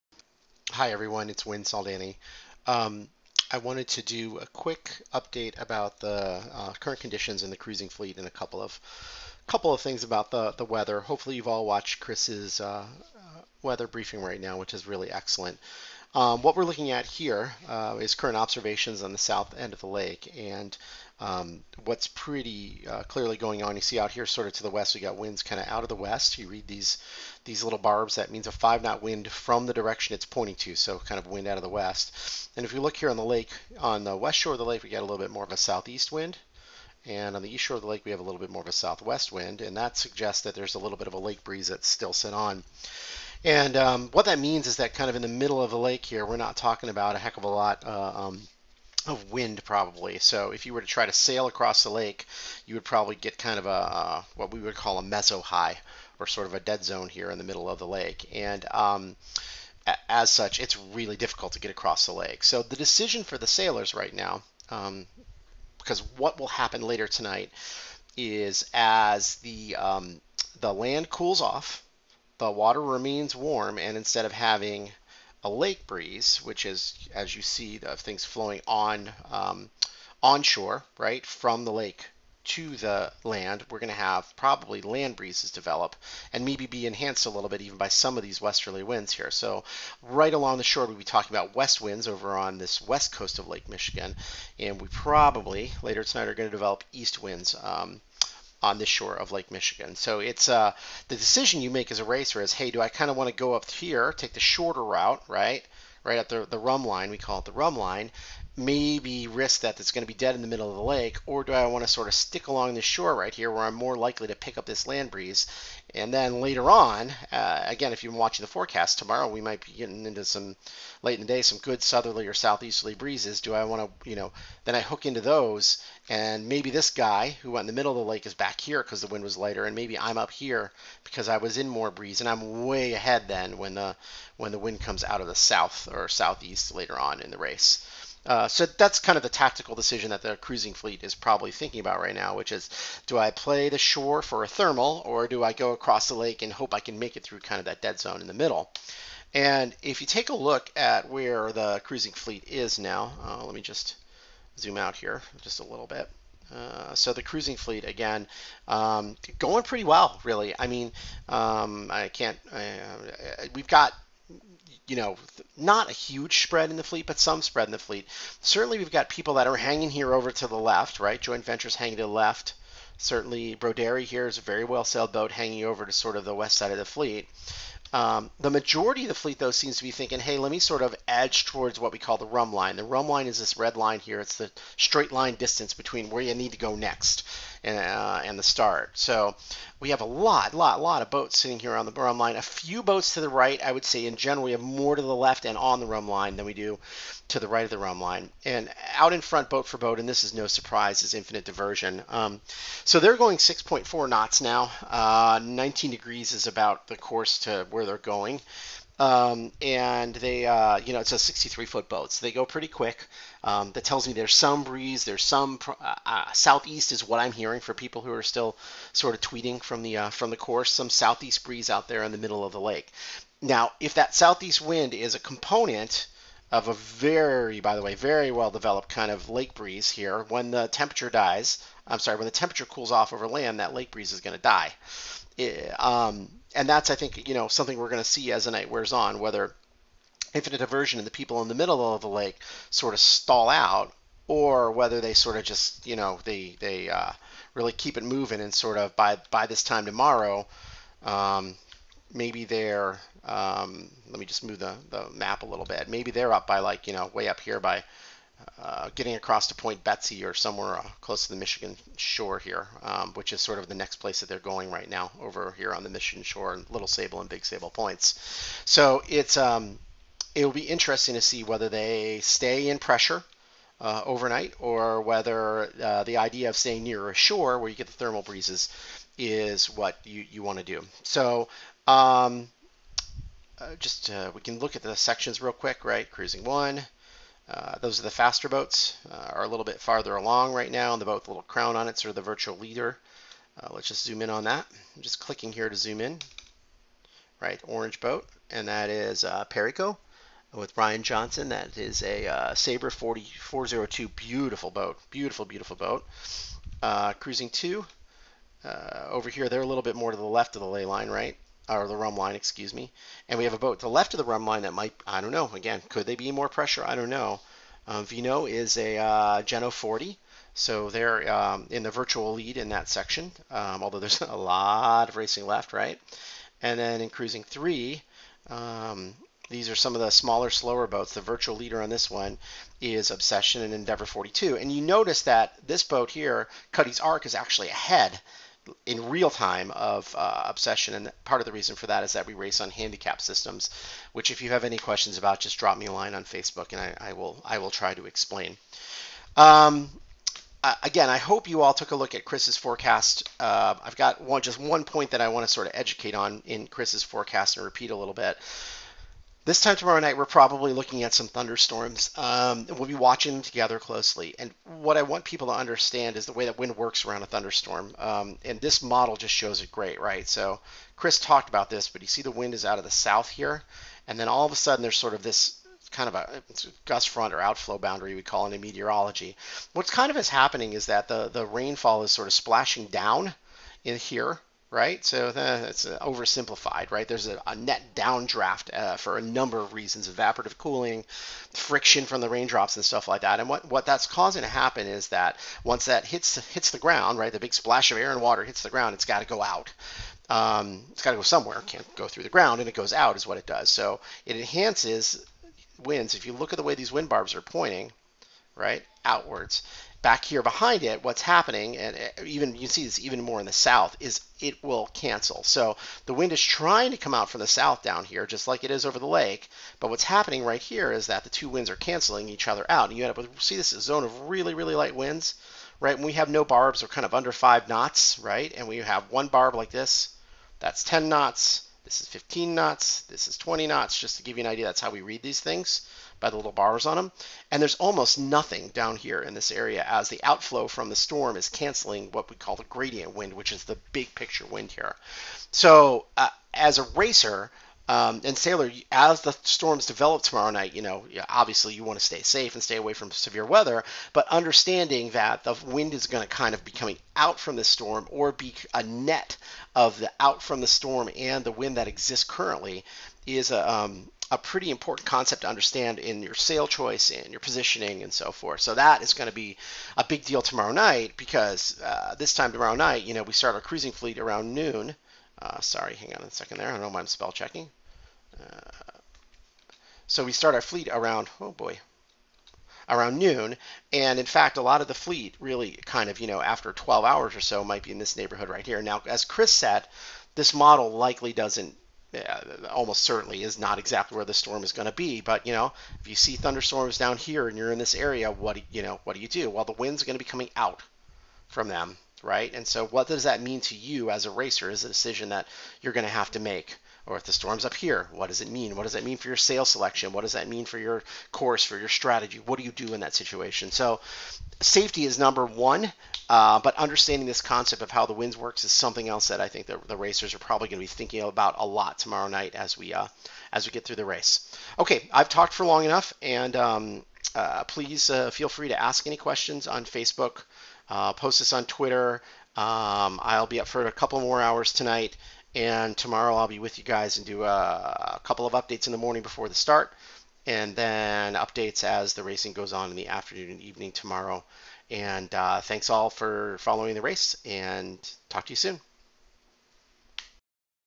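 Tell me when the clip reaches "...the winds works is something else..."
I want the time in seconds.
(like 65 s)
518 s.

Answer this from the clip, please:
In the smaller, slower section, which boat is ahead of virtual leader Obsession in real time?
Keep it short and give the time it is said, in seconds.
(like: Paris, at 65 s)
Cuddy's Arc, at 336 s.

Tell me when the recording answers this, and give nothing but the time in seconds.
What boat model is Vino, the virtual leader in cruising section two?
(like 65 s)
319 s.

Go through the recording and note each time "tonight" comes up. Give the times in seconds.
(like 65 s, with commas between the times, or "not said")
67 s, 96 s, 534 s.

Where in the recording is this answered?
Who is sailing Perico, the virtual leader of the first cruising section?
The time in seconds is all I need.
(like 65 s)
300 s.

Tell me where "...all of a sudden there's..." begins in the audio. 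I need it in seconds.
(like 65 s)
374 s.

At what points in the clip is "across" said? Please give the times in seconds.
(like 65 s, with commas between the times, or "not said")
51 s, 61 s, 145 s, 259 s.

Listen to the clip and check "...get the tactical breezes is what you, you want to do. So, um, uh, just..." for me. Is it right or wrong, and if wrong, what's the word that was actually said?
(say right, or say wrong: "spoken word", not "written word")
wrong: "thermal", not "tactical".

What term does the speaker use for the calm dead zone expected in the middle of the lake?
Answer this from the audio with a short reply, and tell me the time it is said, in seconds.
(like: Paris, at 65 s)
meso high, at 55 s.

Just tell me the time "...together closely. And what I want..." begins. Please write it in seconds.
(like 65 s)
363 s.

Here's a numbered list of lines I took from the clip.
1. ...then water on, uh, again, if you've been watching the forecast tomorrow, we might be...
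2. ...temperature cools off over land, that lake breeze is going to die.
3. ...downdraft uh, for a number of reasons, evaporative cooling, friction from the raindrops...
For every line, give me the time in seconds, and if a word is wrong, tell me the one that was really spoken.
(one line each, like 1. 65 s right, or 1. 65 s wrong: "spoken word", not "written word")
1. 116 s wrong: "later", not "water"
2. 232 s right
3. 387 s right.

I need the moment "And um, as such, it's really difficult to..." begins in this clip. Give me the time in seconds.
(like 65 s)
58 s.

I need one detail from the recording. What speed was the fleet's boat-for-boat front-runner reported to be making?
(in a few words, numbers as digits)
6.4 knots.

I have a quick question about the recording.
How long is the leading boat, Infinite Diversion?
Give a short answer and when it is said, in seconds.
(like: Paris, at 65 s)
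63 foot, at 211 s.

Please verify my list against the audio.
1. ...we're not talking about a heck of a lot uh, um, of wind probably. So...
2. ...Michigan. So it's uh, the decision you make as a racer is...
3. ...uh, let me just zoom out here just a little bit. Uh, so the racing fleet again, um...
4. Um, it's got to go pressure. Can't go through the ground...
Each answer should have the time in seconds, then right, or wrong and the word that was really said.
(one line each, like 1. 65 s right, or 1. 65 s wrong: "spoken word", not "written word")
1. 46 s right
2. 99 s right
3. 153 s wrong: "cruising", not "racing"
4. 400 s wrong: "somewhere", not "pressure".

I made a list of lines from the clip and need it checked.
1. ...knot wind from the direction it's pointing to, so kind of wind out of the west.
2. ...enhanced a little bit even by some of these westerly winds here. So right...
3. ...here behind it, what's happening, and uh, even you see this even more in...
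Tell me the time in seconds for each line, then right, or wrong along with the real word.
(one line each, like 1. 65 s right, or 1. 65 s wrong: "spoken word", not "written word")
1. 28 s right
2. 86 s right
3. 410 s right.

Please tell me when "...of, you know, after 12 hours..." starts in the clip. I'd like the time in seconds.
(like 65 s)
486 s.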